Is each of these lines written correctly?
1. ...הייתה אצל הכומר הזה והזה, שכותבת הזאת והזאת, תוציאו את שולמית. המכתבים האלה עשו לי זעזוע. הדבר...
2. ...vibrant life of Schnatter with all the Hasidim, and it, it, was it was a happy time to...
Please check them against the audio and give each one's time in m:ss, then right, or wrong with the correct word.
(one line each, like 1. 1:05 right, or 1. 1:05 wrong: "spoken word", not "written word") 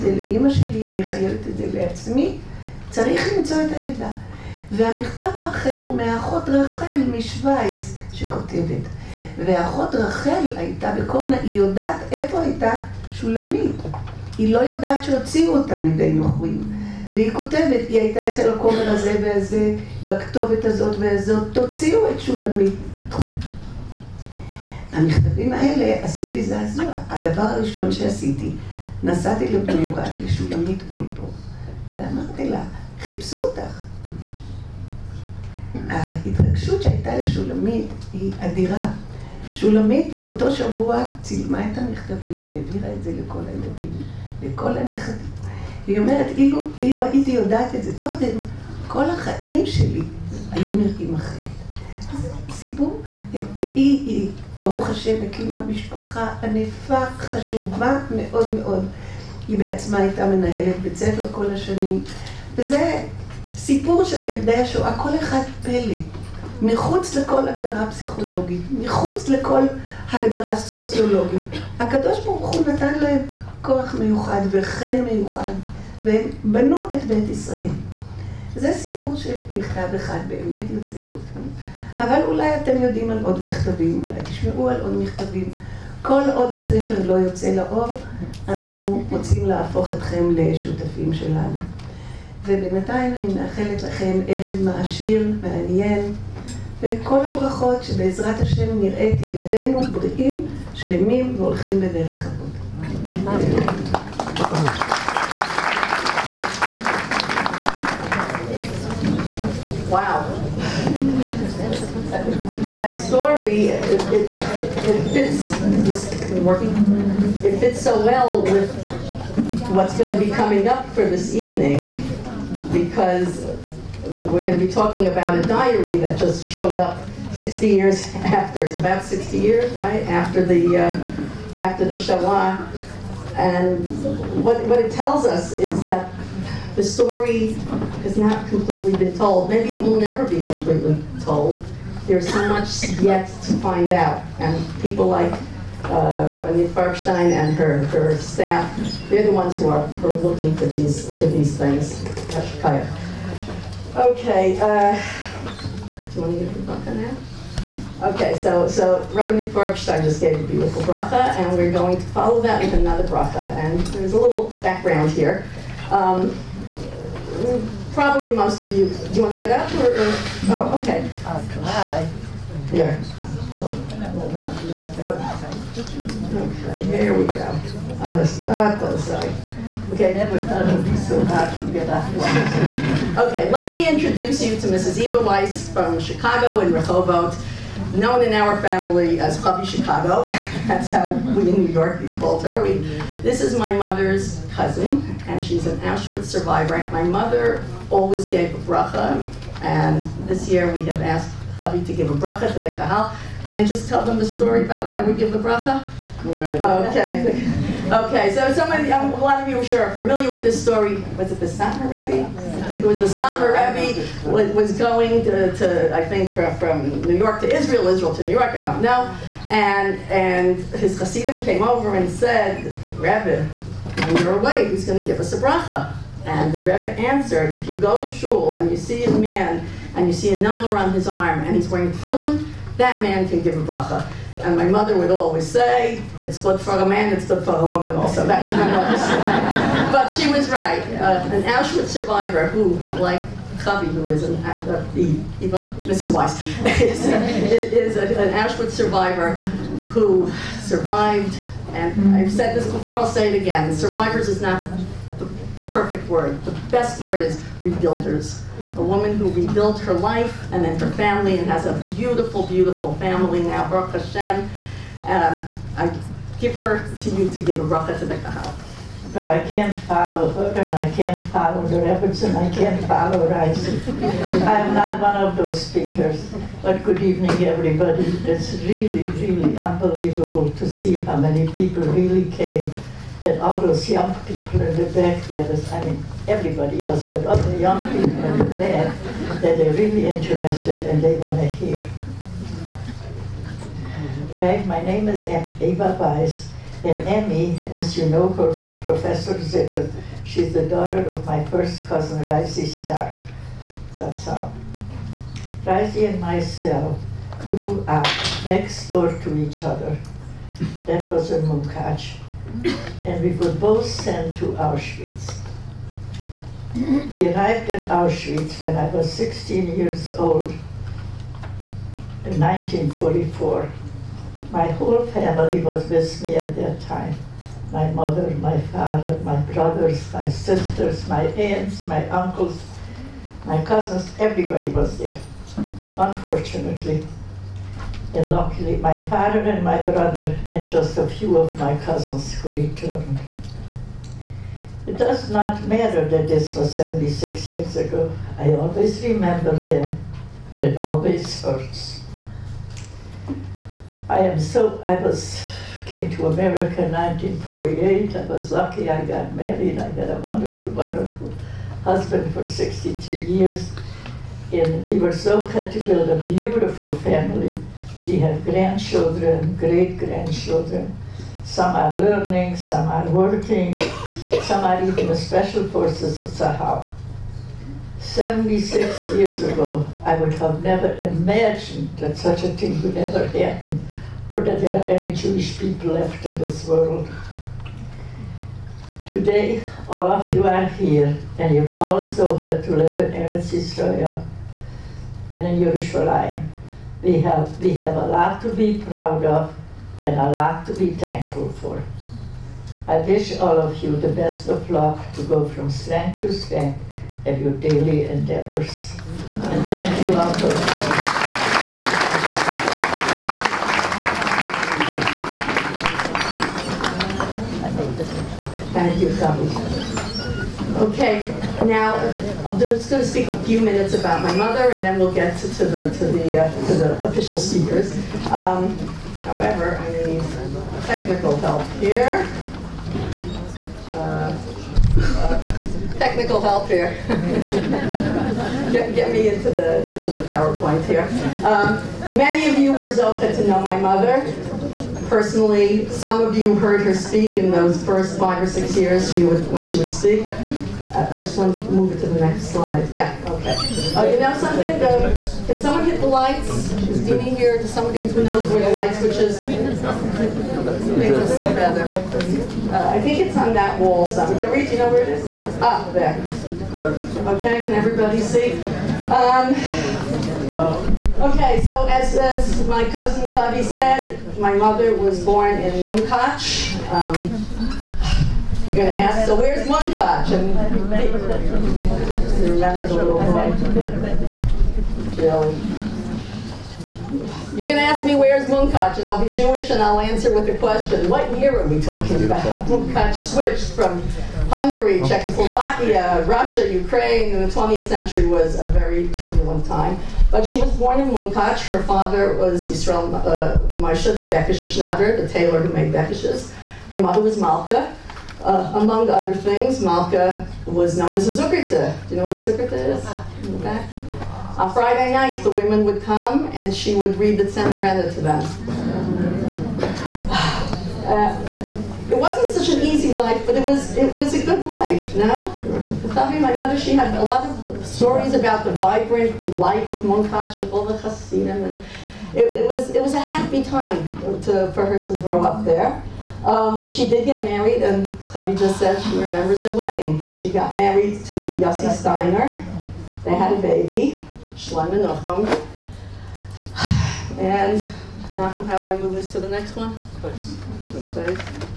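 1. 0:17 wrong: "בכתובת", not "שכותבת"
2. 8:48 wrong: "Munkach", not "Schnatter".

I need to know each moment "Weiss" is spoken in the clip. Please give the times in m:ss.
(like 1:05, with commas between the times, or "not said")
3:05, 4:06, 4:55.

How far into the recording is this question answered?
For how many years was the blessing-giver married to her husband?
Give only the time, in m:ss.
6:02.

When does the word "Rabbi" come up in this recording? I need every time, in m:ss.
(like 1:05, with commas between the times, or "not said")
2:26, 2:39.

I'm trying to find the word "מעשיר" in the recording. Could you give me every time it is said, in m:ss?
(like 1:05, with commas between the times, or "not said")
1:34.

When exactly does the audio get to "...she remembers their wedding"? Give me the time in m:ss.
8:59.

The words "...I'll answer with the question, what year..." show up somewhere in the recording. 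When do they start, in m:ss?
8:09.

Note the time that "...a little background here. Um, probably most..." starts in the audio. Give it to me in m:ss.
2:44.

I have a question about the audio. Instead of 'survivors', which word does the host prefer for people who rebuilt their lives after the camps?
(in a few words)
Rebuilders.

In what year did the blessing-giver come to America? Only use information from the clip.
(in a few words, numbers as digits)
1948.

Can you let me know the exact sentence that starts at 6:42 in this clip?
I wish all of you the best of luck to go from strength to strength of your daily endeavors.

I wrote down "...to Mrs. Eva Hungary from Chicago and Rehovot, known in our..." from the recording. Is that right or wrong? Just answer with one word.
wrong.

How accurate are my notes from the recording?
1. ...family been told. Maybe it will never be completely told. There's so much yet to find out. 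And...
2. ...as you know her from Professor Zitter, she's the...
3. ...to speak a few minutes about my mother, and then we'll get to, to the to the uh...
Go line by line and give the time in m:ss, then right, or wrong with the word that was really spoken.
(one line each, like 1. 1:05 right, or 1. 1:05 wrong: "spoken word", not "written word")
1. 2:18 wrong: "completely", not "family"
2. 4:57 right
3. 7:03 right.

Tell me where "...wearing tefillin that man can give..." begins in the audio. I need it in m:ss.
3:51.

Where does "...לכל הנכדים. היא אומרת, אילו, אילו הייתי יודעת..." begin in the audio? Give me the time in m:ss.
0:44.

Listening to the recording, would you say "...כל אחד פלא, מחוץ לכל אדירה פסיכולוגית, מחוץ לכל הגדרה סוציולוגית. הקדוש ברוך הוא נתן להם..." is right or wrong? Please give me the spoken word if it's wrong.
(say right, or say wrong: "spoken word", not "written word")
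wrong: "הגדרה", not "אדירה".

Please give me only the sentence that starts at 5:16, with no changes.
We arrived in Auschwitz when I was 16 years old in 1944.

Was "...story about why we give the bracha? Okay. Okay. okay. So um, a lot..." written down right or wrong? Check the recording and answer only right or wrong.
right.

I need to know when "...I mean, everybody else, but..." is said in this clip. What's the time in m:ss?
4:45.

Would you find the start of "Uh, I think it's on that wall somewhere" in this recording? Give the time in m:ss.
7:39.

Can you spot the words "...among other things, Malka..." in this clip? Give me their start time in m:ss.
8:28.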